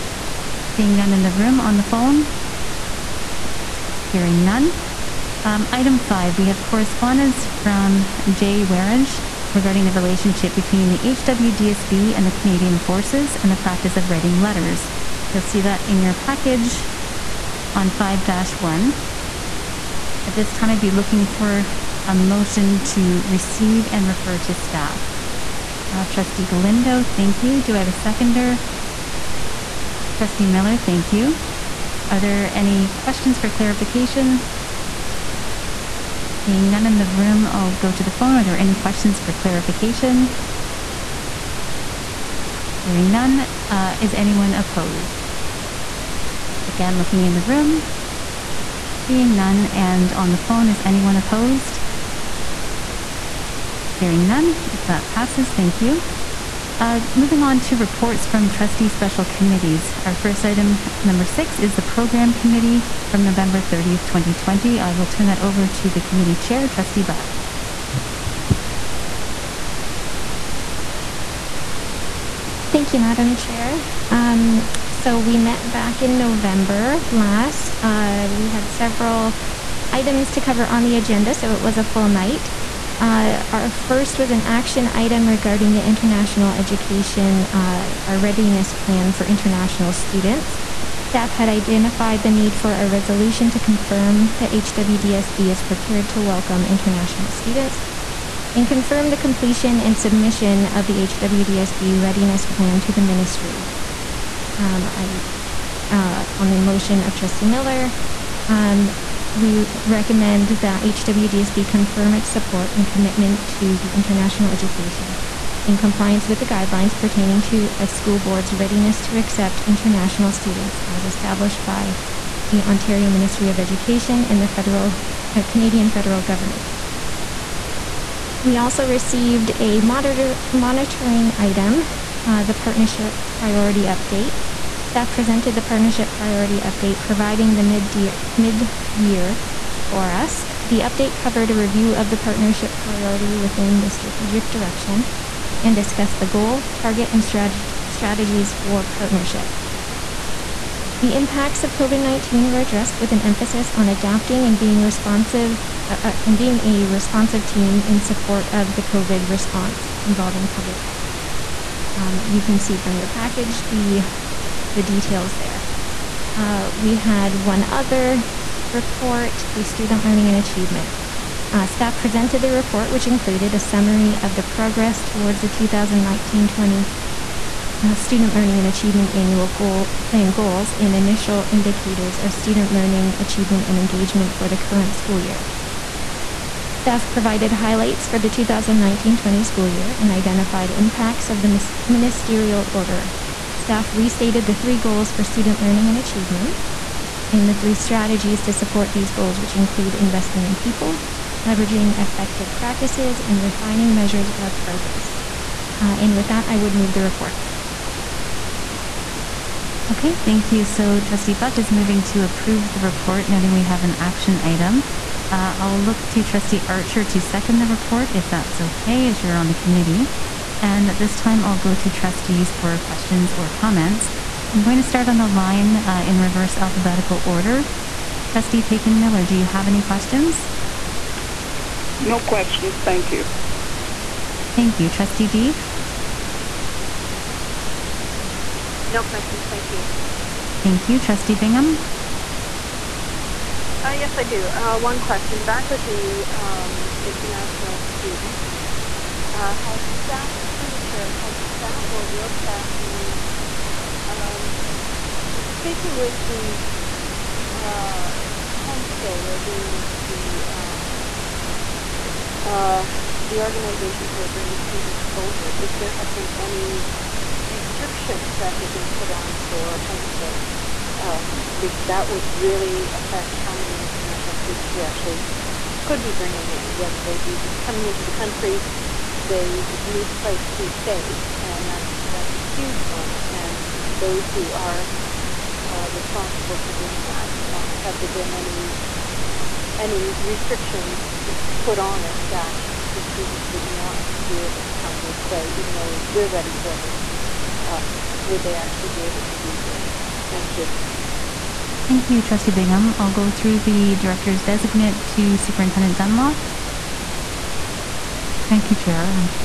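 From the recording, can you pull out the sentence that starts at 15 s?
You'll see that in your package on 5 1.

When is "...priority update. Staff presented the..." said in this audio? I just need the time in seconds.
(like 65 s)
133 s.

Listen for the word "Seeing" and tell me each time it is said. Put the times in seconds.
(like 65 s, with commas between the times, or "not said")
0 s, 36 s, 49 s.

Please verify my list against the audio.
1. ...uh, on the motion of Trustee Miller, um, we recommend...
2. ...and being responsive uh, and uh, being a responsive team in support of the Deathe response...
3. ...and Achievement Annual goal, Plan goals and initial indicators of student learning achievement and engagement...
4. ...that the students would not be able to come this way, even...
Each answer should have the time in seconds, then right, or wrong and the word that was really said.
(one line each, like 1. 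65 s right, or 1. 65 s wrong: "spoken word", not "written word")
1. 105 s right
2. 154 s wrong: "COVID", not "Deathe"
3. 178 s right
4. 292 s right.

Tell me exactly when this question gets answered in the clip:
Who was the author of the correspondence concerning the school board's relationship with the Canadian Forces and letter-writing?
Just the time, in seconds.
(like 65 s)
8 s.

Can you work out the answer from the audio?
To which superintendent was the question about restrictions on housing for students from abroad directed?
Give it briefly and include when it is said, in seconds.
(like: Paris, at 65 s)
Superintendent Dunlop, at 305 s.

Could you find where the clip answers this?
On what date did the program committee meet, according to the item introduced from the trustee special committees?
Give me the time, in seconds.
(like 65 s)
63 s.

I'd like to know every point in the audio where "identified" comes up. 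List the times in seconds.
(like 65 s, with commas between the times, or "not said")
91 s, 190 s.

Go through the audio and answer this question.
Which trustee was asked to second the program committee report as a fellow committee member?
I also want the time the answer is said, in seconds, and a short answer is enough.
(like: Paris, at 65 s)
Trustee Archer, at 216 s.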